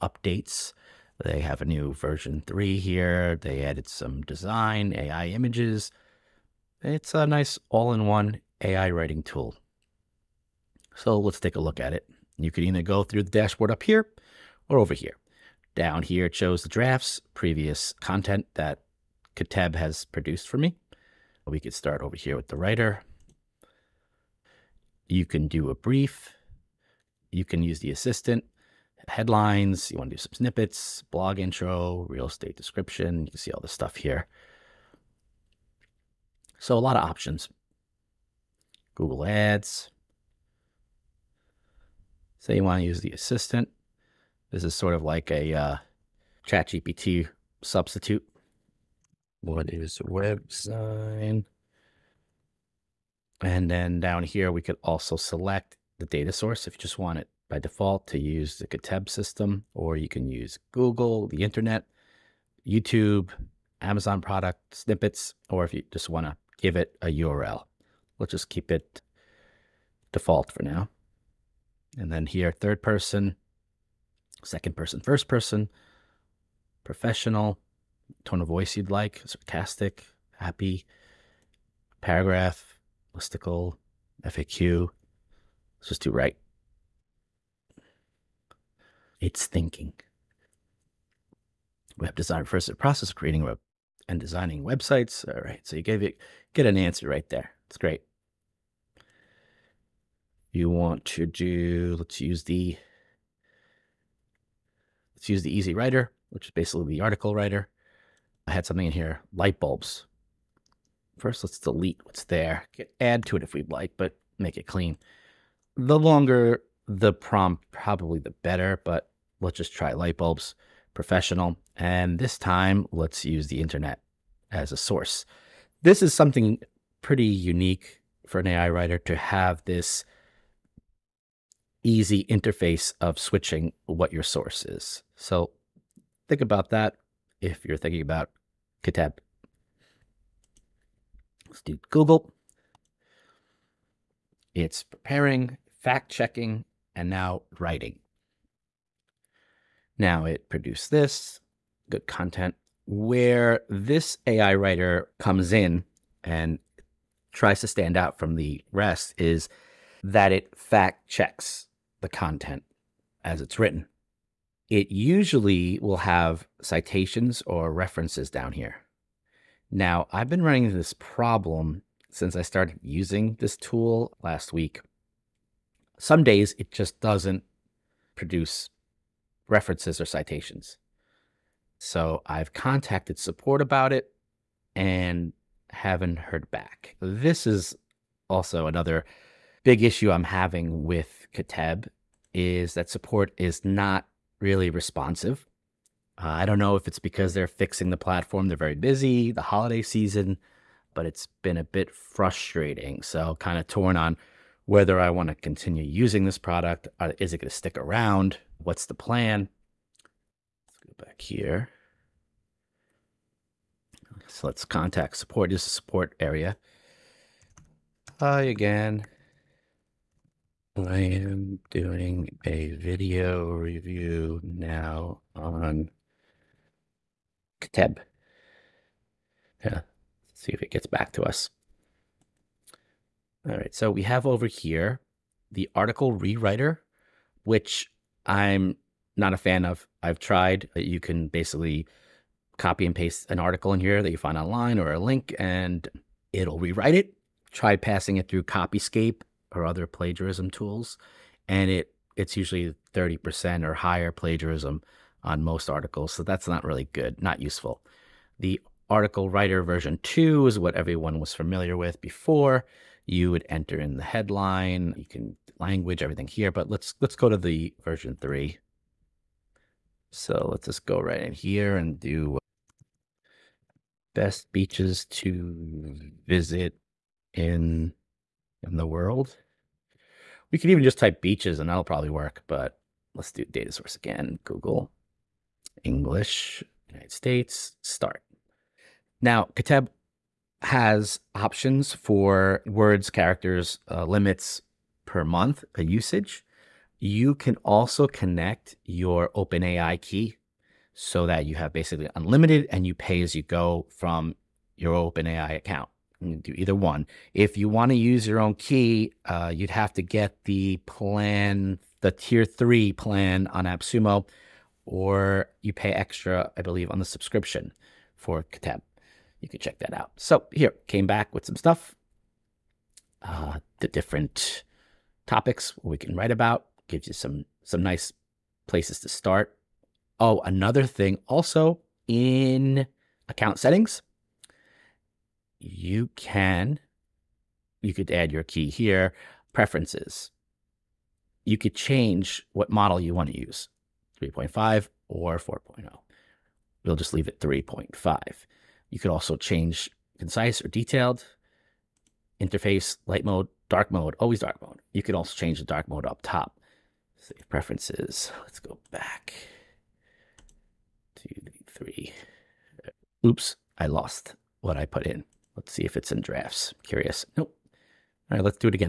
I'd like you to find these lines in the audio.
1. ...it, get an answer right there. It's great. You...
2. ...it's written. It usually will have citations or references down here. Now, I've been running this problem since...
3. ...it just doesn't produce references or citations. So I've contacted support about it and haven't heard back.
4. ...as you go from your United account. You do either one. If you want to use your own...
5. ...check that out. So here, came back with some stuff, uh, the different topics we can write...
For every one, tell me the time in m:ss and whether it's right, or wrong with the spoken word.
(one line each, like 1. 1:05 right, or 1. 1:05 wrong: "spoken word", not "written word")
1. 1:36 right
2. 2:43 right
3. 2:56 right
4. 5:03 wrong: "OpenAI", not "United"
5. 5:19 right.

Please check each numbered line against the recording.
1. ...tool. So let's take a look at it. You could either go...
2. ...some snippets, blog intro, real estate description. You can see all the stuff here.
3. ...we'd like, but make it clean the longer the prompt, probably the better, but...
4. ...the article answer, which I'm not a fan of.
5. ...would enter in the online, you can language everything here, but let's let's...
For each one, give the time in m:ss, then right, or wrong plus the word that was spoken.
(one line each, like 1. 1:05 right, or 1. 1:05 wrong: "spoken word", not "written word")
1. 0:09 right
2. 0:30 right
3. 1:53 right
4. 3:55 wrong: "rewriter", not "answer"
5. 4:23 wrong: "headline", not "online".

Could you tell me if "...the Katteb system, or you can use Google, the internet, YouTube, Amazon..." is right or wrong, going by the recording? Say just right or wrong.
right.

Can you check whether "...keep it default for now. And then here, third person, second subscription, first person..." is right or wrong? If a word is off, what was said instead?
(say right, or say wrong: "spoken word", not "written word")
wrong: "person", not "subscription".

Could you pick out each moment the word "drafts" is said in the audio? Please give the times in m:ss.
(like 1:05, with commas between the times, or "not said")
0:16, 6:06.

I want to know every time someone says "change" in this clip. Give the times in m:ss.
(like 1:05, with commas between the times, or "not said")
5:41, 5:49, 5:55.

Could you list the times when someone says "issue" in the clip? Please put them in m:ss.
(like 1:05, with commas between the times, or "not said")
3:09.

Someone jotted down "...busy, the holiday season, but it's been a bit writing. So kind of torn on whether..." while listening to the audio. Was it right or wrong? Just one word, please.
wrong.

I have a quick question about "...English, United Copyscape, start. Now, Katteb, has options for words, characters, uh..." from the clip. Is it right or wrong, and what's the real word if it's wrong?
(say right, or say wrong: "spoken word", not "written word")
wrong: "States", not "Copyscape".